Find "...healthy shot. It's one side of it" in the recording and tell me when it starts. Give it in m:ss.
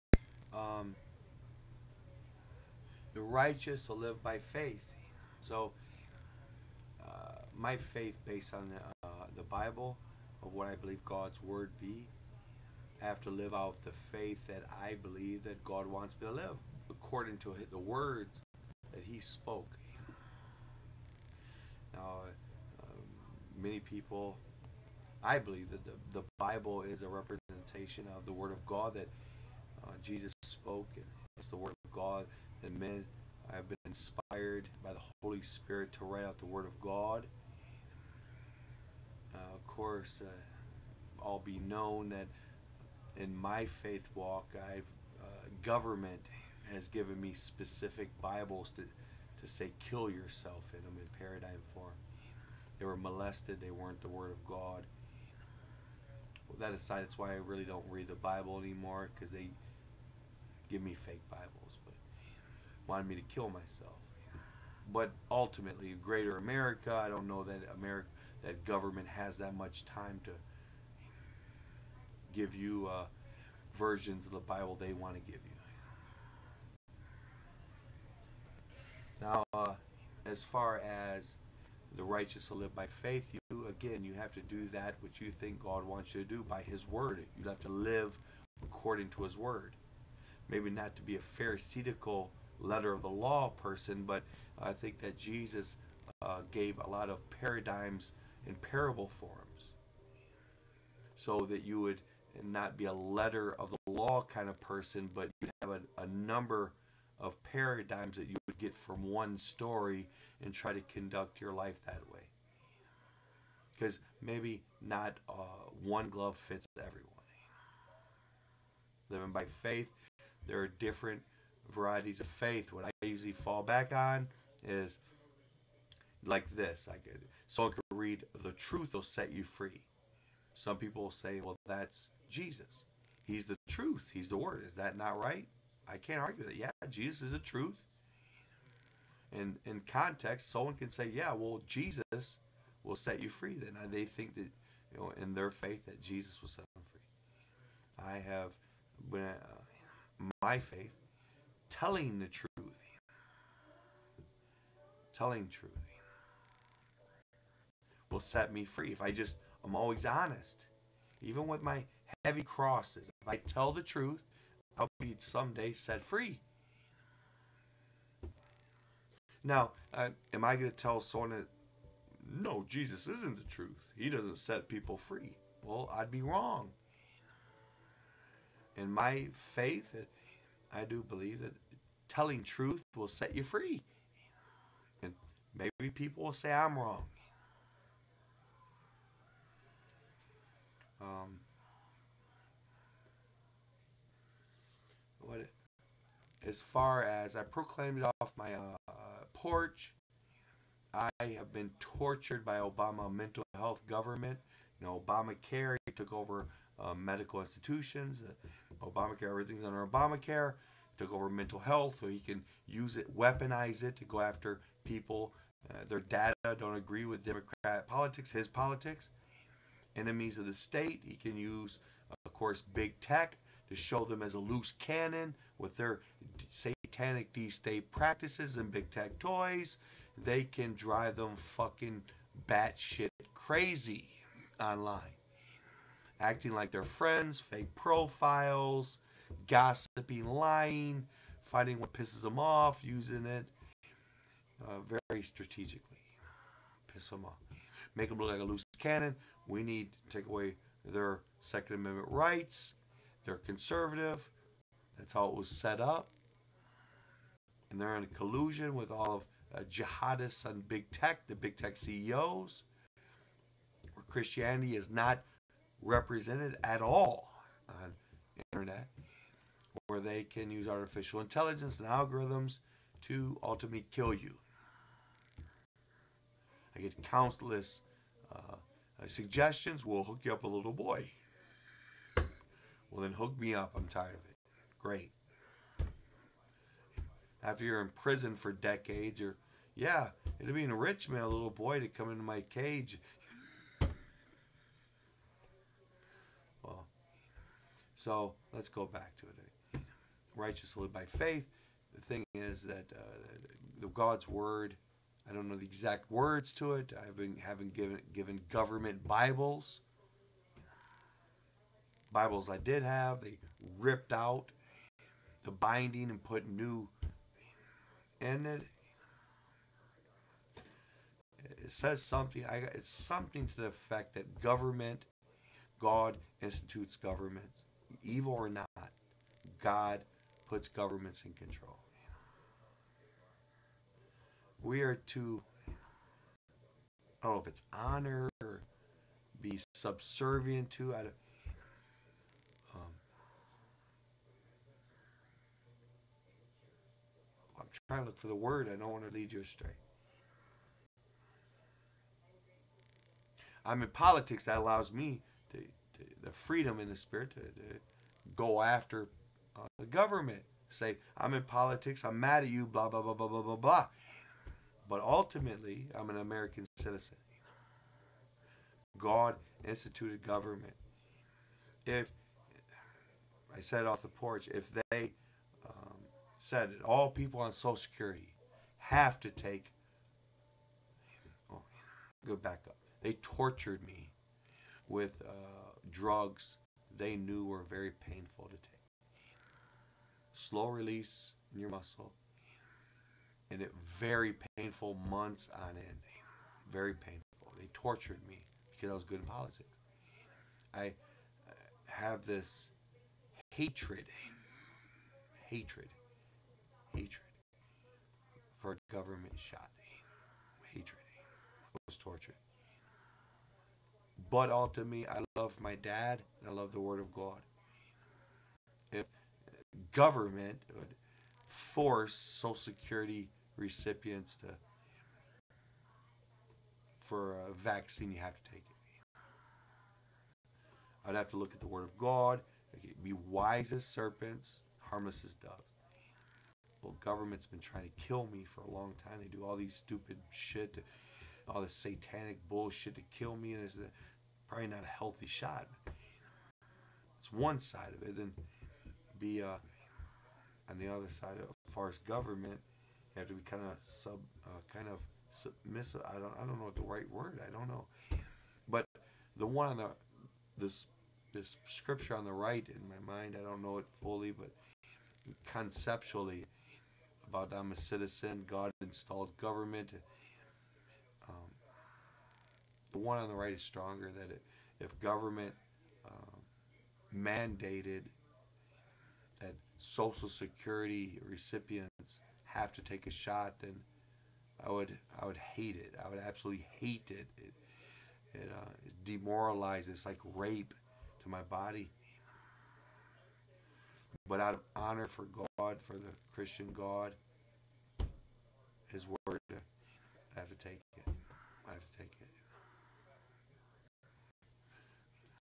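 7:24.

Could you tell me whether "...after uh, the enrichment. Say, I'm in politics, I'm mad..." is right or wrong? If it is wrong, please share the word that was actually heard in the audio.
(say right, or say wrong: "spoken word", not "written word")
wrong: "government", not "enrichment".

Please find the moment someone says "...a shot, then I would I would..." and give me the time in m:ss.
8:03.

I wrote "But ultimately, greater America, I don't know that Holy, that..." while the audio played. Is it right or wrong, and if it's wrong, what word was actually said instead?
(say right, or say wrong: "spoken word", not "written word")
wrong: "America", not "Holy".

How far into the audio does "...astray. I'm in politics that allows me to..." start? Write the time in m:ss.
5:49.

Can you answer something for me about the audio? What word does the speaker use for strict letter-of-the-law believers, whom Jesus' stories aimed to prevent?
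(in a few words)
Pharisaical.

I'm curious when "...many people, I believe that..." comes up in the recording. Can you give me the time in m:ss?
0:23.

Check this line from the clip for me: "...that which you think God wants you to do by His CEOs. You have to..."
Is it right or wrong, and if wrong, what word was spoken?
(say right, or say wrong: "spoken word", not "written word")
wrong: "Word", not "CEOs".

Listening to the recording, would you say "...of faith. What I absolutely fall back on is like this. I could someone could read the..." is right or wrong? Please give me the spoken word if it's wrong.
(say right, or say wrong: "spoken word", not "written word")
wrong: "usually", not "absolutely".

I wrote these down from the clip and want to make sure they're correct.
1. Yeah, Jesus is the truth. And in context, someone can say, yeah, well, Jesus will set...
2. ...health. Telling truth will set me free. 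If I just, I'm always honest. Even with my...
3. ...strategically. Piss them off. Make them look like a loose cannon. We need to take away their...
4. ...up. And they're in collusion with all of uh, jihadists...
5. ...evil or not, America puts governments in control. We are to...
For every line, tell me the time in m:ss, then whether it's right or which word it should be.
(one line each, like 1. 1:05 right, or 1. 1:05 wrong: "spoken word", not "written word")
1. 2:16 right
2. 2:32 wrong: "truth", not "health"
3. 4:05 right
4. 4:15 right
5. 5:28 wrong: "God", not "America".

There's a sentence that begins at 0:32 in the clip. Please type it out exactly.
and men have been inspired by the Holy Spirit to write out the Word of God.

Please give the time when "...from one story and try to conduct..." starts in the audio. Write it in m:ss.
1:48.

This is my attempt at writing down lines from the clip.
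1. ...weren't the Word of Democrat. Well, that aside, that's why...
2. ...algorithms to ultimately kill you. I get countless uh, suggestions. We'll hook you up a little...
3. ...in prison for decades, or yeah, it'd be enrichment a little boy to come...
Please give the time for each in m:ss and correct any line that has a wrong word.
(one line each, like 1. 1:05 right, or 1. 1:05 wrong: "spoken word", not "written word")
1. 0:53 wrong: "God", not "Democrat"
2. 4:31 right
3. 4:47 right.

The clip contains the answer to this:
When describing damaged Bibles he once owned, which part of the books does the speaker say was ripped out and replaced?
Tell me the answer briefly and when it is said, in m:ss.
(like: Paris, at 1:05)
Binding, at 5:15.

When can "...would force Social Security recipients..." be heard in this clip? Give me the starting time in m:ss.
7:00.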